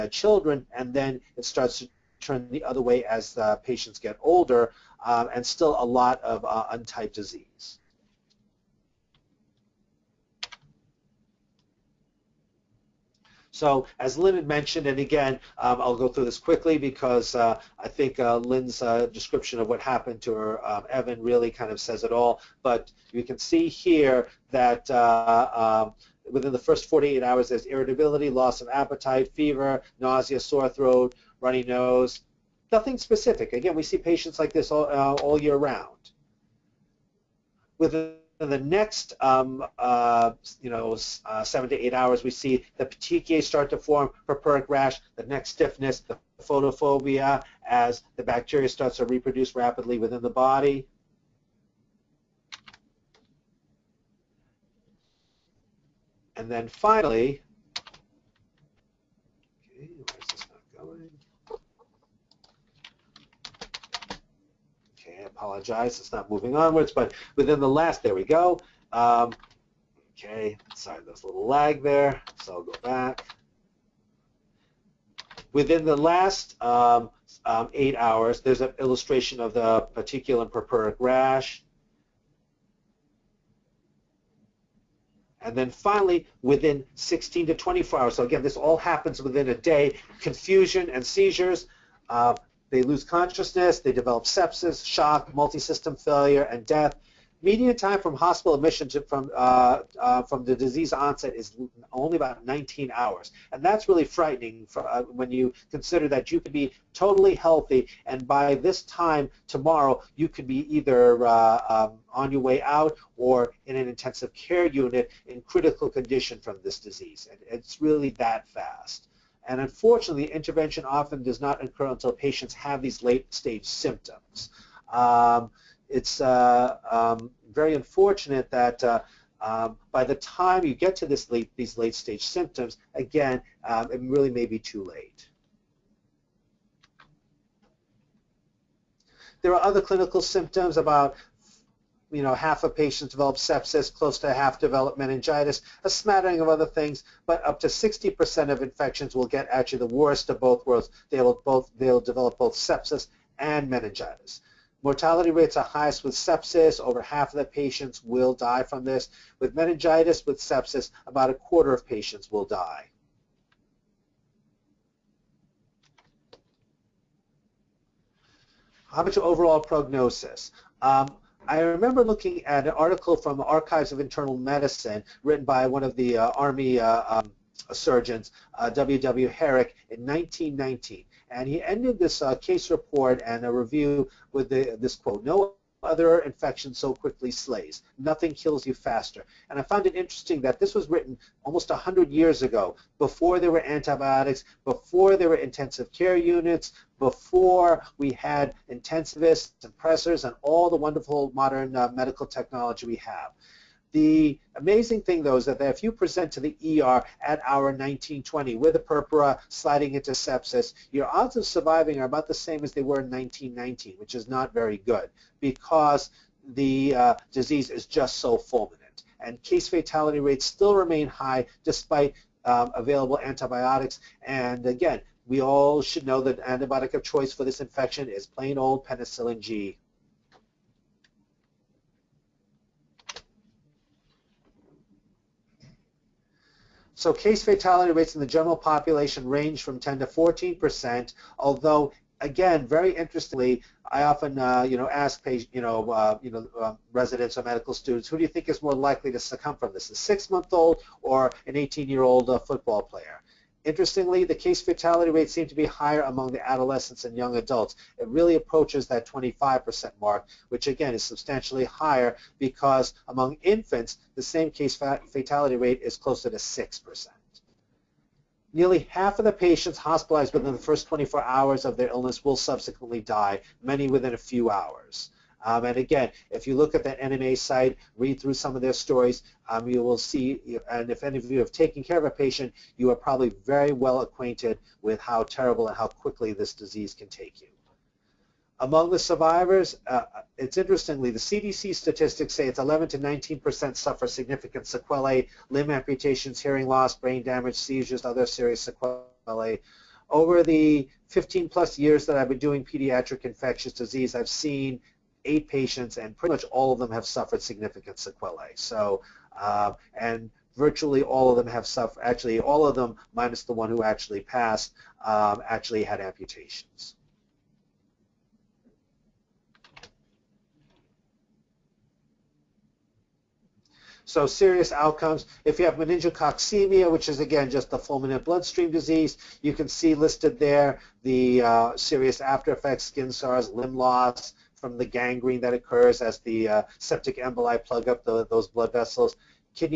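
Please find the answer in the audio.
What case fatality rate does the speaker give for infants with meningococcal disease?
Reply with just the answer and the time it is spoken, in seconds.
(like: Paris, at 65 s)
6%, at 266 s.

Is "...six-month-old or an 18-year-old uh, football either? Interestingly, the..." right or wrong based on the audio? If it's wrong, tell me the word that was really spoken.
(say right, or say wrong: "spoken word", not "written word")
wrong: "player", not "either".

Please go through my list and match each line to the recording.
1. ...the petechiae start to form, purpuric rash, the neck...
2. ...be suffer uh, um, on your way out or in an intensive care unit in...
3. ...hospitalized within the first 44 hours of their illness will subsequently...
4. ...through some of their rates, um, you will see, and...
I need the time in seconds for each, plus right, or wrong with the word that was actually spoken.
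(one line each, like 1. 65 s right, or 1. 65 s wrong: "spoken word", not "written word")
1. 42 s right
2. 110 s wrong: "either", not "suffer"
3. 269 s wrong: "24", not "44"
4. 278 s wrong: "stories", not "rates".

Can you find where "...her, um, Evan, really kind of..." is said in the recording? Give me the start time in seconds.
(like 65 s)
20 s.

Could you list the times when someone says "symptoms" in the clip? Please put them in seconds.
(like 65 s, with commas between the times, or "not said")
123 s, 132 s, 140 s.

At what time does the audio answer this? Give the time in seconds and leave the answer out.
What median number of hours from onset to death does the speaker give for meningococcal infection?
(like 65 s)
102 s.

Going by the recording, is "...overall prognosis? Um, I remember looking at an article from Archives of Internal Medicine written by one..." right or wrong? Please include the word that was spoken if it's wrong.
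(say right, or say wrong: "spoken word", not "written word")
right.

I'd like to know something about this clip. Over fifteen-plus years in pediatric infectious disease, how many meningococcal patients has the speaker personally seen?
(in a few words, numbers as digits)
8.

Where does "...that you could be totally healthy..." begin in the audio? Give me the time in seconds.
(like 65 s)
106 s.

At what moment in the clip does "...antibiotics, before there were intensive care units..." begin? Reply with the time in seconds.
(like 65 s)
193 s.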